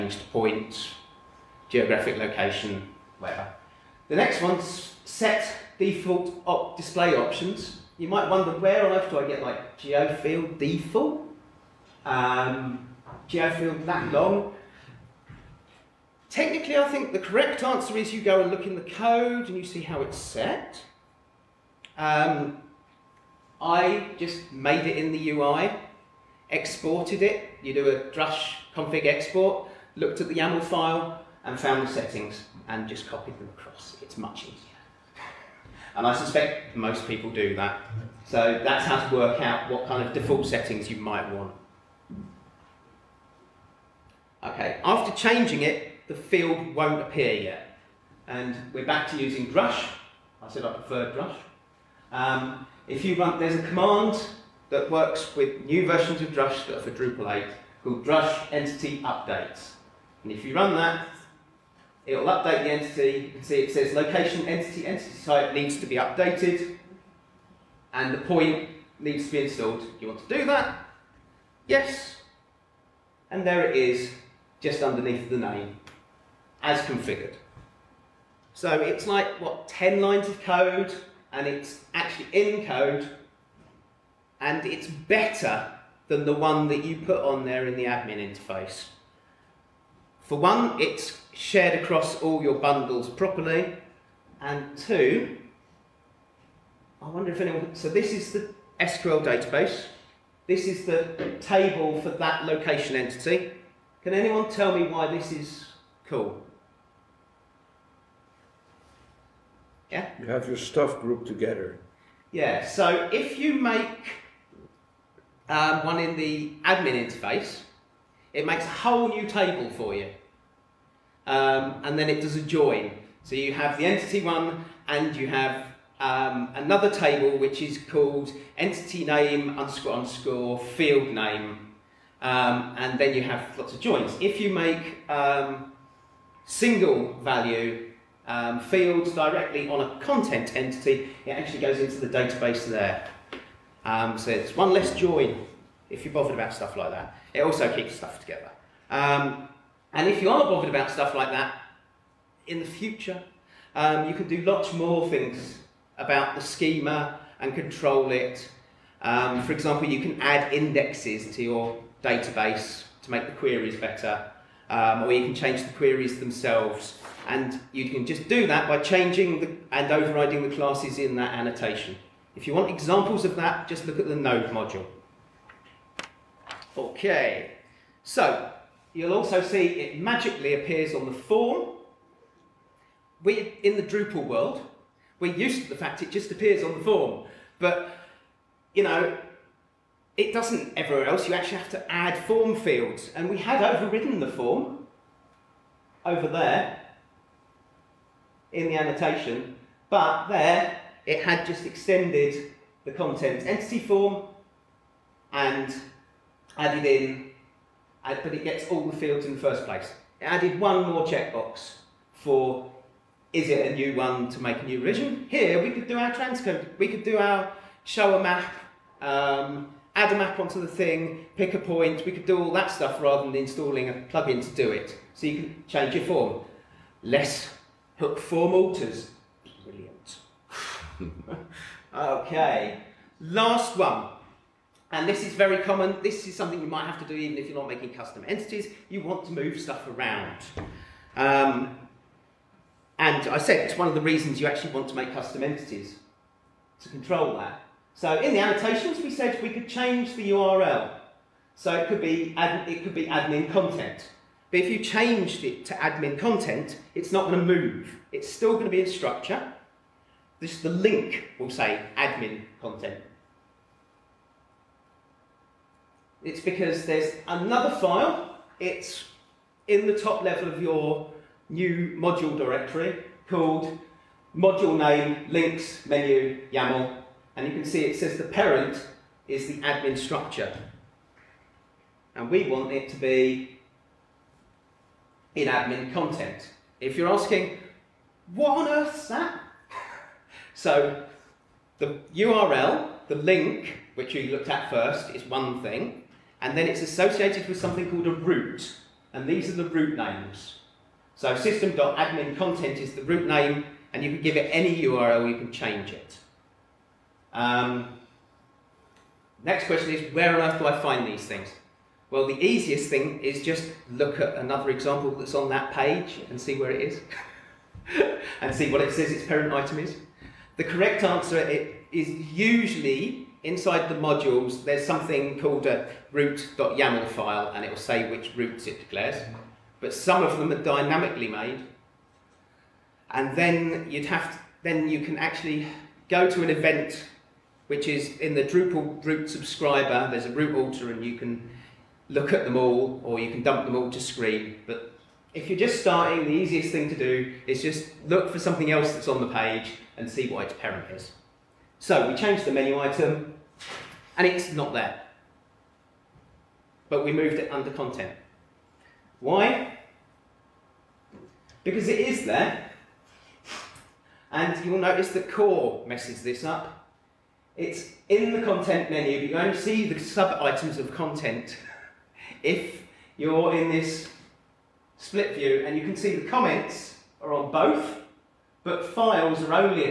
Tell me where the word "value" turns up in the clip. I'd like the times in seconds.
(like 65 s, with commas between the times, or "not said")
137 s.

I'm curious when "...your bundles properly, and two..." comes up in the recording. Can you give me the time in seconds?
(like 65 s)
92 s.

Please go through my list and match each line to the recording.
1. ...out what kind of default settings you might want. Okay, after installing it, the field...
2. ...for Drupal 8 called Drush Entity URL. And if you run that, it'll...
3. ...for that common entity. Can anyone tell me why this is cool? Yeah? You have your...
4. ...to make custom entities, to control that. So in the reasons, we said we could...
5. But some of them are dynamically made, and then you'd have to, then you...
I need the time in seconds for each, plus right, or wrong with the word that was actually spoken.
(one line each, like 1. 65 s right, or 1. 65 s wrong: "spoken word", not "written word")
1. 39 s wrong: "changing", not "installing"
2. 56 s wrong: "Updates", not "URL"
3. 102 s wrong: "location", not "common"
4. 244 s wrong: "annotations", not "reasons"
5. 329 s right.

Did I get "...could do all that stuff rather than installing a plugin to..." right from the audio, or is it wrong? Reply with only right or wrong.
right.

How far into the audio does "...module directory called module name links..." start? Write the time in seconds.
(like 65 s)
271 s.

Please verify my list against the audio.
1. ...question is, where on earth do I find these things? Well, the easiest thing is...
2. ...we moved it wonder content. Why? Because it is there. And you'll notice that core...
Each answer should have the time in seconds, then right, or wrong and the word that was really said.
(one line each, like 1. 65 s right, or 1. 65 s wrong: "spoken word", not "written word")
1. 309 s right
2. 357 s wrong: "under", not "wonder".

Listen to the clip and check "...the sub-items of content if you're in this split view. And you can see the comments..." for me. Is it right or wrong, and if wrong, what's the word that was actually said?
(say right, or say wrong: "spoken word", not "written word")
right.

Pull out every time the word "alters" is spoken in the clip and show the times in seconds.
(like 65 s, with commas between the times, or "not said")
228 s, 340 s.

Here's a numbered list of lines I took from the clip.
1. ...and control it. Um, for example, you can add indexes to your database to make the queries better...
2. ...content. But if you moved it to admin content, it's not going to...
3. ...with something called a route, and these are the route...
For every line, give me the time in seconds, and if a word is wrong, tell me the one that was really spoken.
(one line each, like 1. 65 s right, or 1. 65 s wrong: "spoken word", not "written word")
1. 157 s right
2. 253 s wrong: "changed", not "moved"
3. 297 s right.